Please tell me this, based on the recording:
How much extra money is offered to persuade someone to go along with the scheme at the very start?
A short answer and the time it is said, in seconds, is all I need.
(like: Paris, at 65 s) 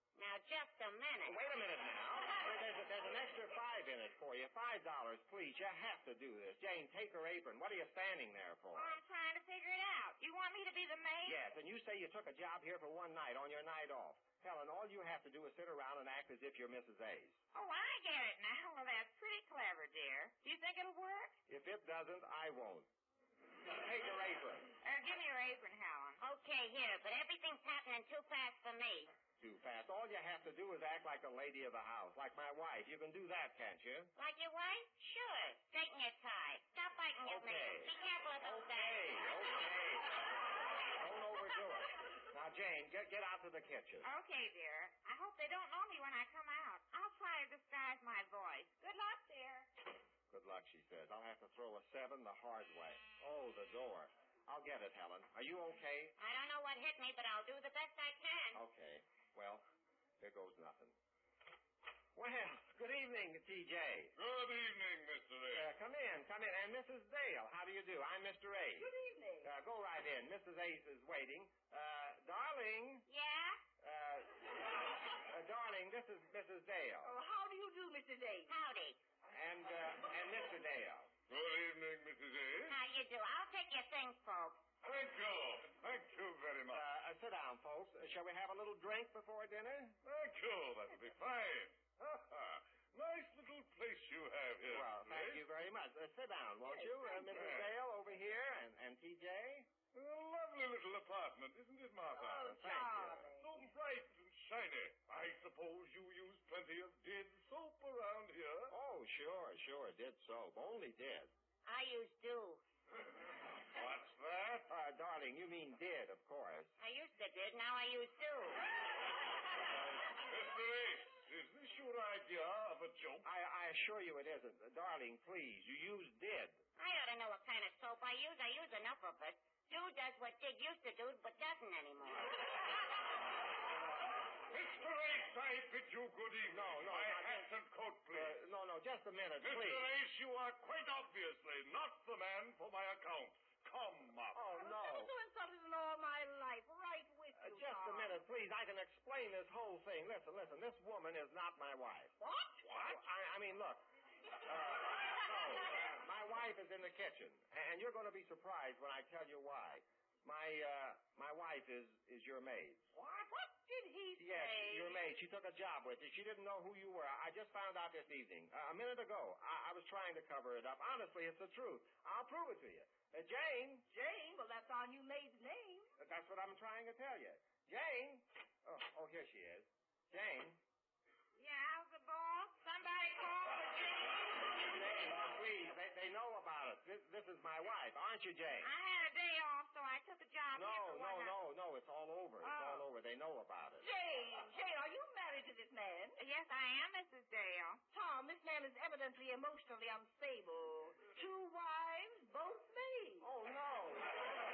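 $5, at 4 s.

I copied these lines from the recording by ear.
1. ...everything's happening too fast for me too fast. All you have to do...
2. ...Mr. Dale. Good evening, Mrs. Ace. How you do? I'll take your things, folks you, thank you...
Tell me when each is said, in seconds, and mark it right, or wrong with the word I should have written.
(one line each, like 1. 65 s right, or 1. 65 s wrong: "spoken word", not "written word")
1. 27 s right
2. 80 s right.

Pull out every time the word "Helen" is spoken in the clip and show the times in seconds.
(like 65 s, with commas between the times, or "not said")
14 s, 25 s, 54 s.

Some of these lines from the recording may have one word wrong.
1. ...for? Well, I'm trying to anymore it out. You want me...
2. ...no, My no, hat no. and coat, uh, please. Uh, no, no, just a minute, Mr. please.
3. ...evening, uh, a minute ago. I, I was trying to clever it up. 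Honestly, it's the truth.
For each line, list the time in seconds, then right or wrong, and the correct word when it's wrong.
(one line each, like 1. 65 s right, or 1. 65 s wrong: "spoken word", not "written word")
1. 8 s wrong: "figure", not "anymore"
2. 136 s right
3. 168 s wrong: "cover", not "clever".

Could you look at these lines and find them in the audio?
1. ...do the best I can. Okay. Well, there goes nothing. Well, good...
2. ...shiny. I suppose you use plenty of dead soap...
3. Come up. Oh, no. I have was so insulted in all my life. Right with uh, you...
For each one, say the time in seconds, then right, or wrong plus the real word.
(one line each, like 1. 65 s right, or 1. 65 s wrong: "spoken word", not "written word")
1. 57 s right
2. 104 s right
3. 143 s right.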